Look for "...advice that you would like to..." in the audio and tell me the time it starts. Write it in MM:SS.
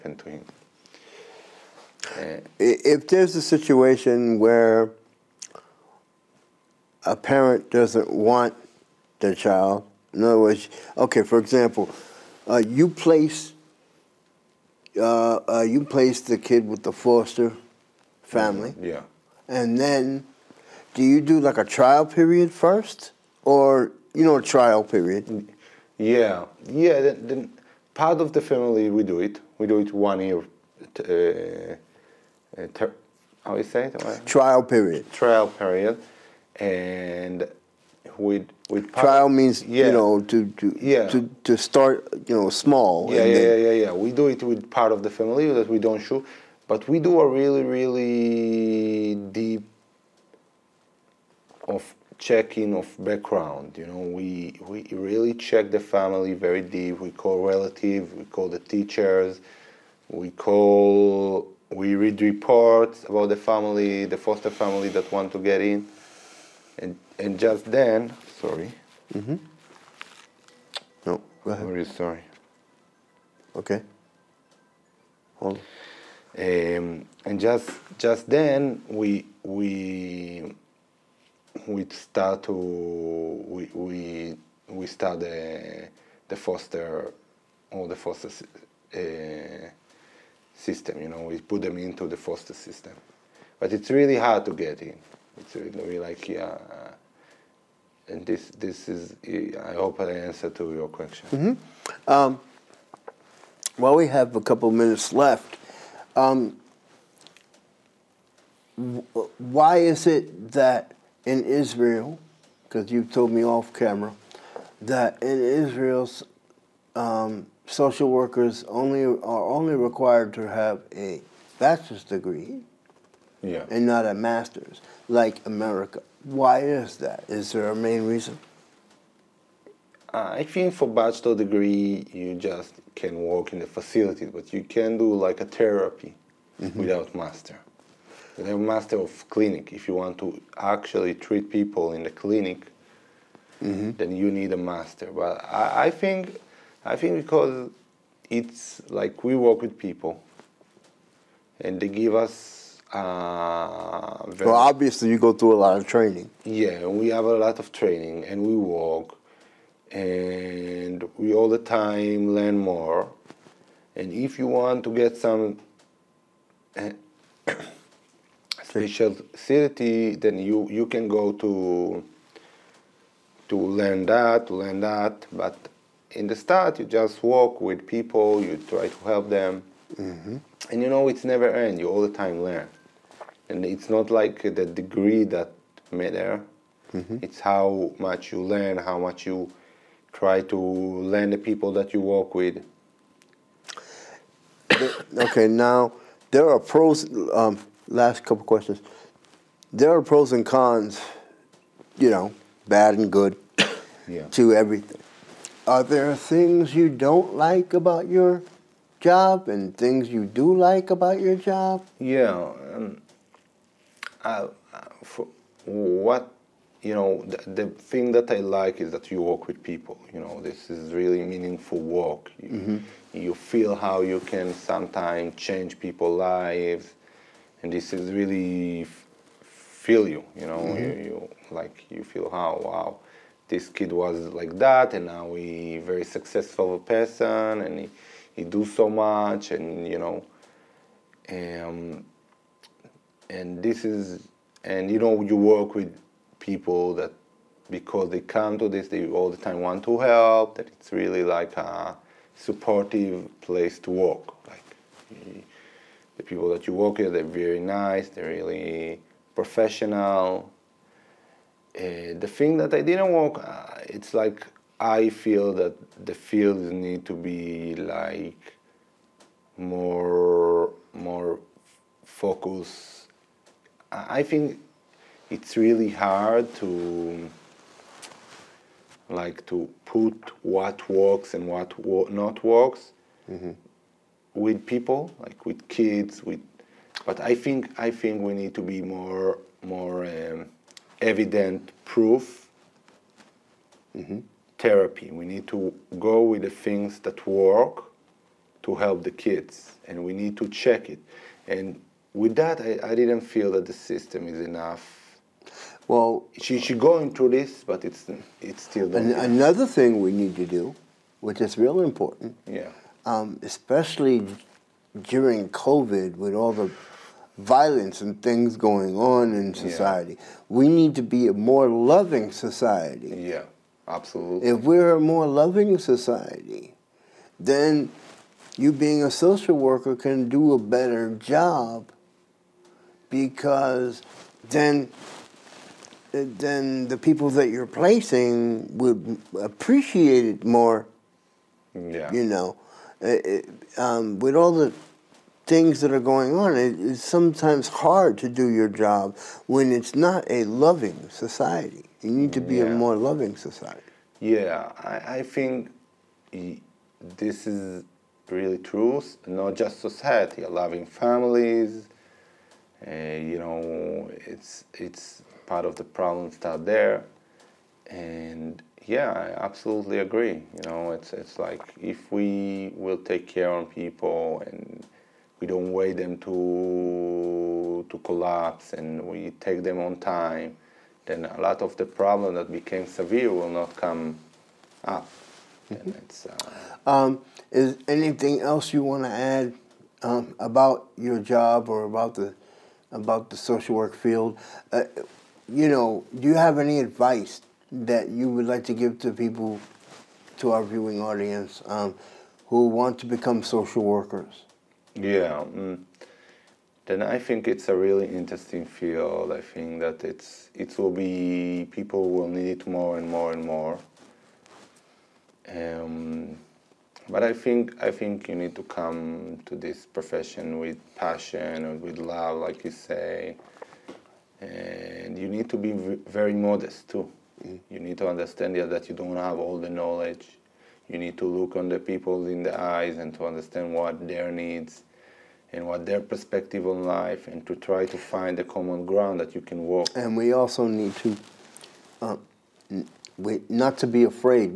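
06:36.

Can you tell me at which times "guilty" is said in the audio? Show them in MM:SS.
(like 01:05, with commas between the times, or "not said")
not said.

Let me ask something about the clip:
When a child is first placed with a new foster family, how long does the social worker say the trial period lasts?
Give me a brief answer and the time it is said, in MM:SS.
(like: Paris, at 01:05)
1 year, at 00:29.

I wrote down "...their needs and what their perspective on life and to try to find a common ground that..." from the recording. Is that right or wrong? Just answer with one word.
right.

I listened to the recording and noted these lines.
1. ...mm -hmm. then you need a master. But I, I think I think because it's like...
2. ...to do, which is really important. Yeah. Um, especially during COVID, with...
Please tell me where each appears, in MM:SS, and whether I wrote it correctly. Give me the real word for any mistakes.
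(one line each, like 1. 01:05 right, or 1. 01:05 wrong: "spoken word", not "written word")
1. 02:23 right
2. 05:10 right.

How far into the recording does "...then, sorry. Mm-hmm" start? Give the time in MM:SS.
01:07.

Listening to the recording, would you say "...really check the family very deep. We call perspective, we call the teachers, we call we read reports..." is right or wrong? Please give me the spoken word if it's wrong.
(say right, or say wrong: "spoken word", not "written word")
wrong: "relative", not "perspective".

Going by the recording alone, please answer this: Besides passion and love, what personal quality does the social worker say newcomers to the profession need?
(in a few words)
Modest.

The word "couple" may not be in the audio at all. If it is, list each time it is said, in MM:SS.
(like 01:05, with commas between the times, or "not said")
01:44, 03:18.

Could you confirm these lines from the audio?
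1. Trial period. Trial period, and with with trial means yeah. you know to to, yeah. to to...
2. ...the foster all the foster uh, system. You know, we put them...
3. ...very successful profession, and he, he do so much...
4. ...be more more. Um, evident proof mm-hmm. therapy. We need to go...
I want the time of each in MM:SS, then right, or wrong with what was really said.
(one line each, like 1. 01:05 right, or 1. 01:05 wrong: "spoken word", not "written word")
1. 00:34 right
2. 01:26 right
3. 03:55 wrong: "person", not "profession"
4. 04:48 right.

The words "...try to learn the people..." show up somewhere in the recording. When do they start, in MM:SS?
03:10.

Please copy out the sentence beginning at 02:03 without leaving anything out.
and not a master's, like America.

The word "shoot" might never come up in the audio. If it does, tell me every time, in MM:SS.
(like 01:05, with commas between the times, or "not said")
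00:46.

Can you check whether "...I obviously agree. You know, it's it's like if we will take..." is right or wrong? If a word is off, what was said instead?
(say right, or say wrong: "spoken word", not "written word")
wrong: "absolutely", not "obviously".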